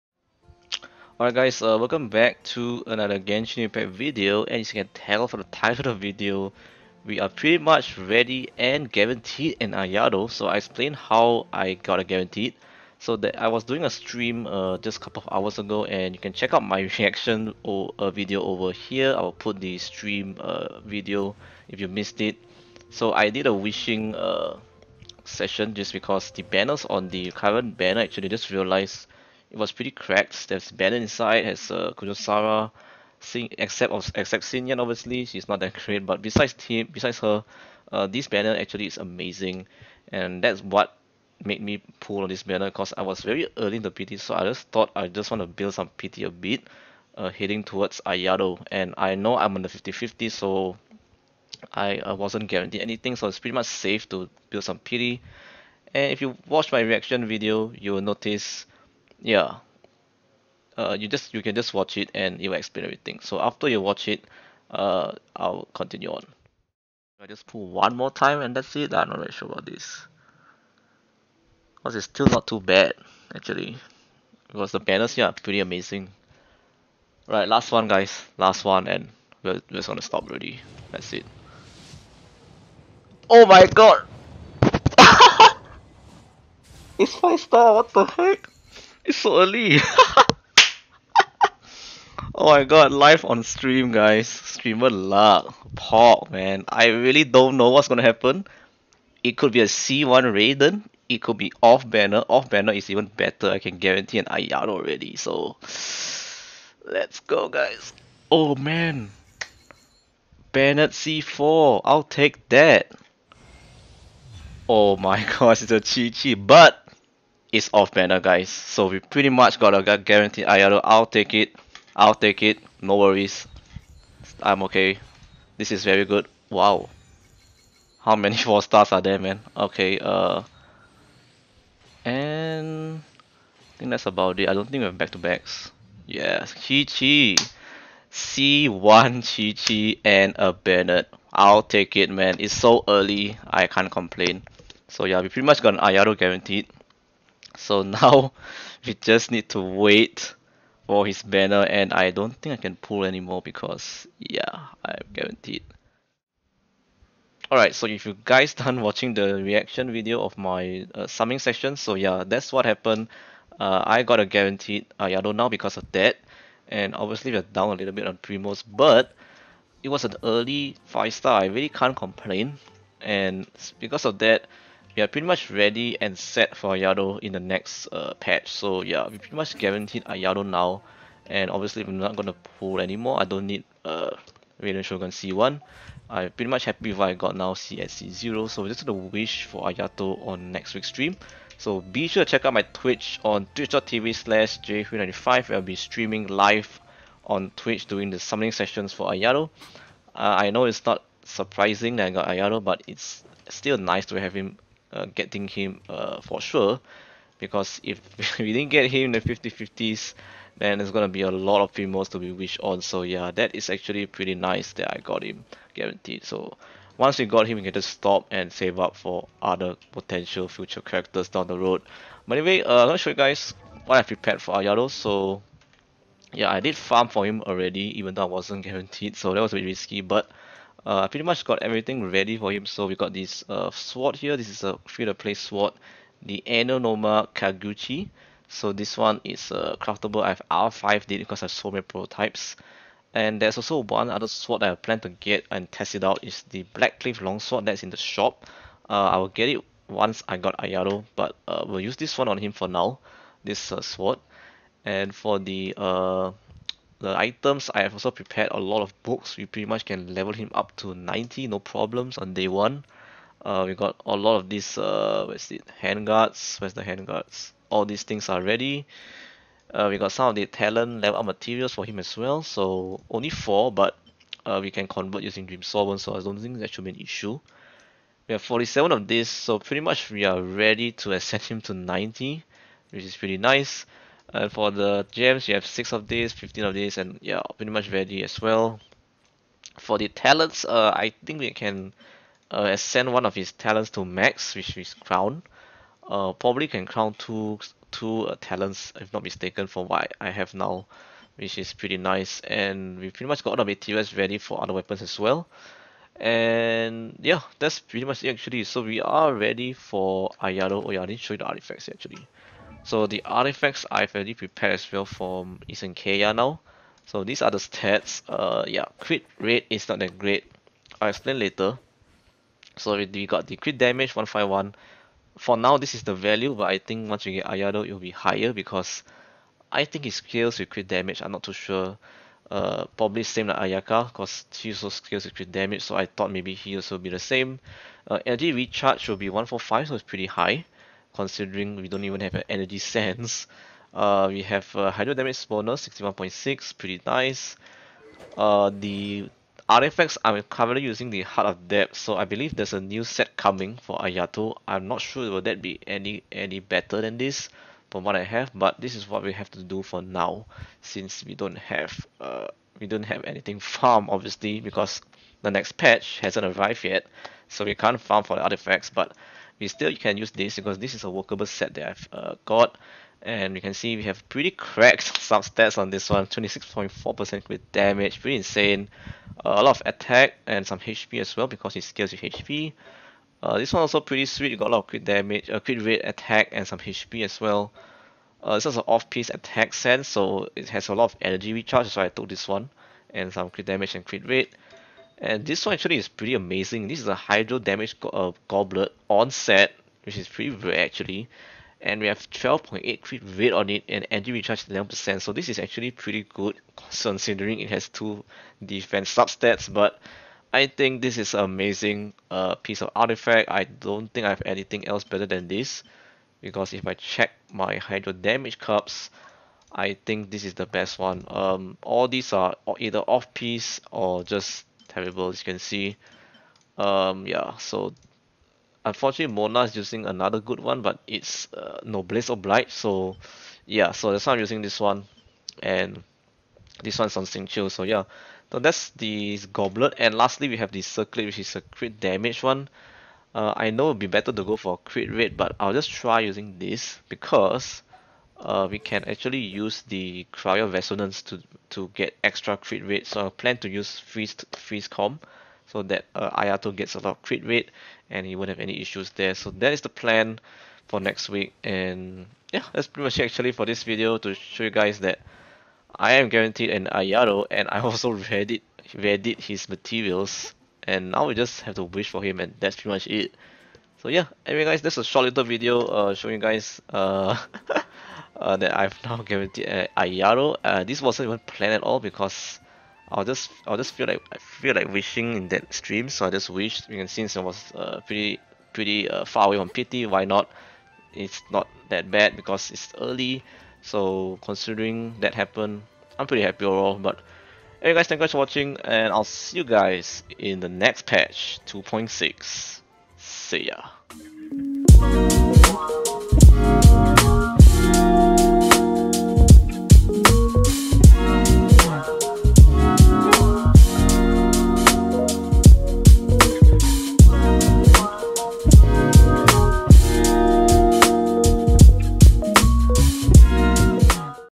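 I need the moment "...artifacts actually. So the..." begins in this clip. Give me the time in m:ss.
5:11.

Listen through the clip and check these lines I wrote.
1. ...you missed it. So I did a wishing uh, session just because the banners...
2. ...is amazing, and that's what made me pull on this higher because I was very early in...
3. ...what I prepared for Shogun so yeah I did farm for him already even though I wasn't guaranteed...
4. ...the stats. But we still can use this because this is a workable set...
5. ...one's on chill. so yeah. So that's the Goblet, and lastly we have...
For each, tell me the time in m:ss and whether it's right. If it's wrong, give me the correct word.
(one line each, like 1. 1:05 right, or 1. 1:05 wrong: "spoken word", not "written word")
1. 0:21 right
2. 0:38 wrong: "banner", not "higher"
3. 3:43 wrong: "Ayato", not "Shogun"
4. 6:08 wrong: "artifacts", not "stats"
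5. 7:16 right.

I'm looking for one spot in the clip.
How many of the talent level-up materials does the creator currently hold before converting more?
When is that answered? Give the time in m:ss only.
4:33.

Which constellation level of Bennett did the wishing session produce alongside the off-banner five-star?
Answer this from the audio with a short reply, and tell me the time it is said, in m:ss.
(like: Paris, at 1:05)
C4, at 1:50.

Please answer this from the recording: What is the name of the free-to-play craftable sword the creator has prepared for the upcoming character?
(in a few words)
Amenoma Kageuchi.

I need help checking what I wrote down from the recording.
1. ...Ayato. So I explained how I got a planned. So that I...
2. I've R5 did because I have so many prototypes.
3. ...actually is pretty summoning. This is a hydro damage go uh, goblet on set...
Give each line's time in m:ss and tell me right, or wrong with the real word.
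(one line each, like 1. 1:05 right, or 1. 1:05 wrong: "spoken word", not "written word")
1. 0:09 wrong: "guaranteed", not "planned"
2. 4:00 right
3. 6:35 wrong: "amazing", not "summoning".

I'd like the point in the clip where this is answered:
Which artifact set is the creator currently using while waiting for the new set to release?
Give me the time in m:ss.
5:51.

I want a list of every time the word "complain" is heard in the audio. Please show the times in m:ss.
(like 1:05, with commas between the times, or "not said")
2:23, 2:51.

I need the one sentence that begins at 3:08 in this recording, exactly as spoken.
So just gonna wish for Ayato on next week's stream.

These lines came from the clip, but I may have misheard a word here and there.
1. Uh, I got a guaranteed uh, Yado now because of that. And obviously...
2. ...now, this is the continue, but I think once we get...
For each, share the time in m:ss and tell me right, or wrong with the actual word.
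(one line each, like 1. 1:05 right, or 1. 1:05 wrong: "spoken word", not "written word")
1. 2:43 right
2. 5:25 wrong: "value", not "continue".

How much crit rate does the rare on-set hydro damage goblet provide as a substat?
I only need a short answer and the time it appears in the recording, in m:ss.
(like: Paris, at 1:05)
12.8, at 6:42.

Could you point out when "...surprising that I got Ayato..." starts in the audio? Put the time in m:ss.
3:21.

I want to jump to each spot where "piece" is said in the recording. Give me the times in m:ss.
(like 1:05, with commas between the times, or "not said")
6:28, 6:52, 7:03.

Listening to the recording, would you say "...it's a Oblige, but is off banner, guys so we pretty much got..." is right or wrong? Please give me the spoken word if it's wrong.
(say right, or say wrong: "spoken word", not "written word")
wrong: "Qiqi", not "Oblige".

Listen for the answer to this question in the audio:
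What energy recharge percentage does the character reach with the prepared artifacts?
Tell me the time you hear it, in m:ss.
5:39.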